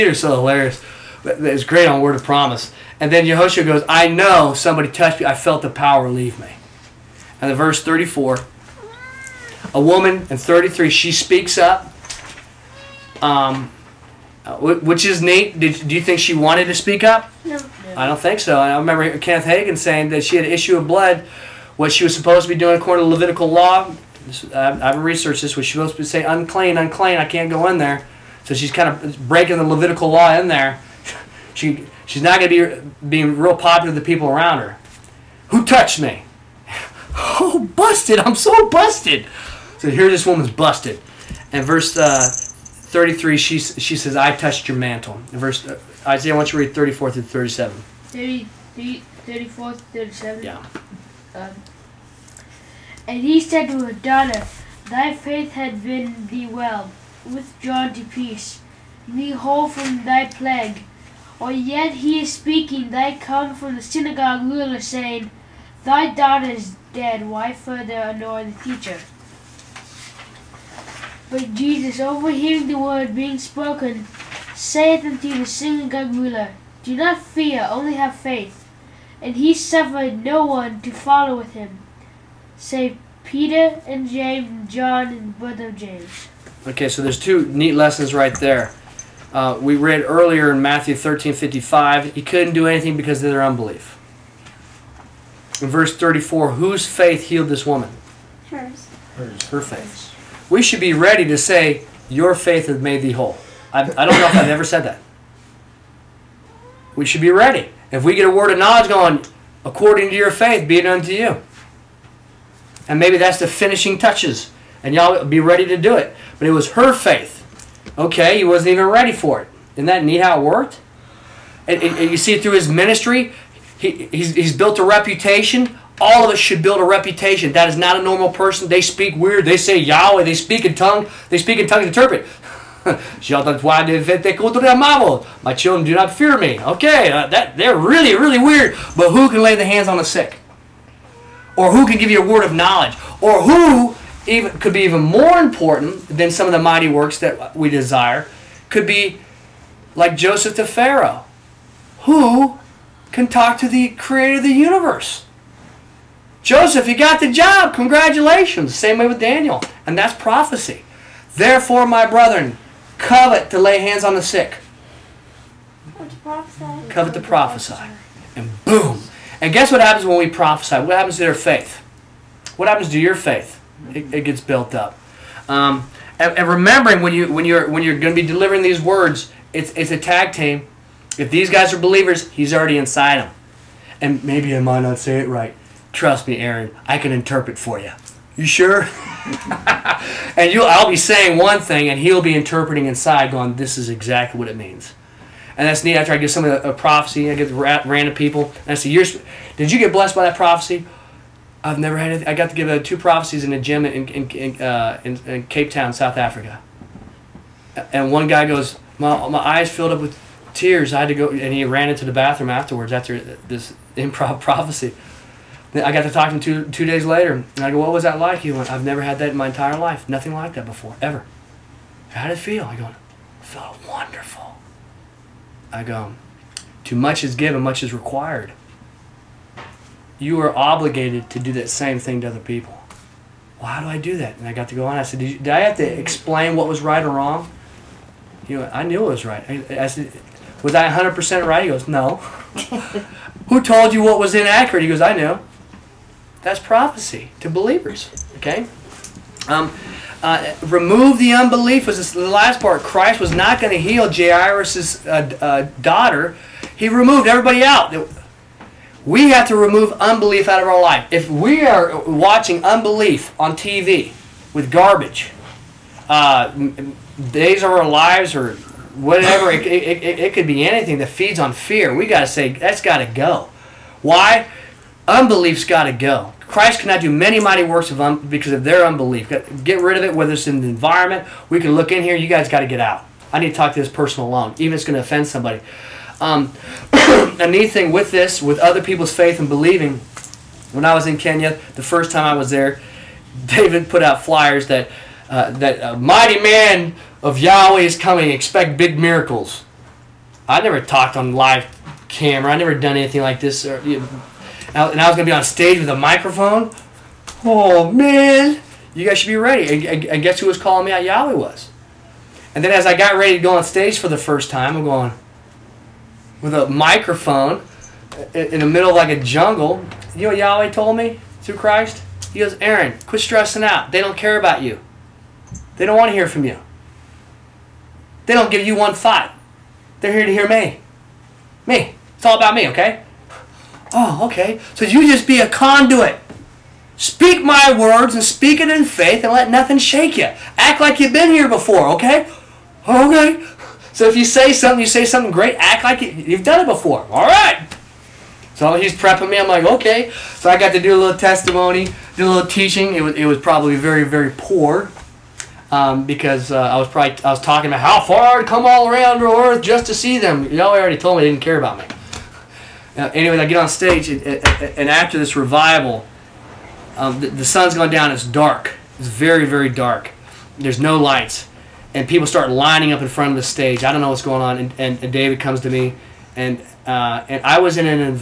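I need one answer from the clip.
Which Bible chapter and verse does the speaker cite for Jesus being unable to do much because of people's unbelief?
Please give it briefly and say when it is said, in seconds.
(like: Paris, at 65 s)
Matthew 13:55, at 90 s.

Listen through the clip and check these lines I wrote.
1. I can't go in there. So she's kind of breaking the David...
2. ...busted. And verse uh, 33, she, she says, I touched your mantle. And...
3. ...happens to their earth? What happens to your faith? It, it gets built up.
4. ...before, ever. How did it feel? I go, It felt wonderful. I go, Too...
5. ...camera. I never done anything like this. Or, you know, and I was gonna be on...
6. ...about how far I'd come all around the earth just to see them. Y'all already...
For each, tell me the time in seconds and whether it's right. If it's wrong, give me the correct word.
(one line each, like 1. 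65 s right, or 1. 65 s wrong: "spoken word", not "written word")
1. 27 s wrong: "Levitical", not "David"
2. 40 s right
3. 170 s wrong: "faith", not "earth"
4. 220 s right
5. 302 s right
6. 357 s right.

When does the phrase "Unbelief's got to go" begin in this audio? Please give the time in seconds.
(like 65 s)
275 s.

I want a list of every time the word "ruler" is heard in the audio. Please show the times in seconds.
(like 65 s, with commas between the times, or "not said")
64 s, 76 s.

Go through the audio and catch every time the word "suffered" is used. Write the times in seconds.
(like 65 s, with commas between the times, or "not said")
79 s.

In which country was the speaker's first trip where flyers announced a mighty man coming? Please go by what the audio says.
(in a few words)
Kenya.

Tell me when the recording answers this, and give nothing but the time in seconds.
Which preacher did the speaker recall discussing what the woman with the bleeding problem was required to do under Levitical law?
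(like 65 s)
19 s.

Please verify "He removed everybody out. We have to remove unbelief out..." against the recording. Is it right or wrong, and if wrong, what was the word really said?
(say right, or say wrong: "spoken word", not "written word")
right.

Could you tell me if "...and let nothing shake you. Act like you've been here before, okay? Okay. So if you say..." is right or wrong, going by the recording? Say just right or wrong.
right.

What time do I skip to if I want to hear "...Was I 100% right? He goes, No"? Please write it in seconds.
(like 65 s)
240 s.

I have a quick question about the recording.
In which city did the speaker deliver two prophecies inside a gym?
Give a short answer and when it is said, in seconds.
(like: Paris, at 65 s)
Cape Town, at 205 s.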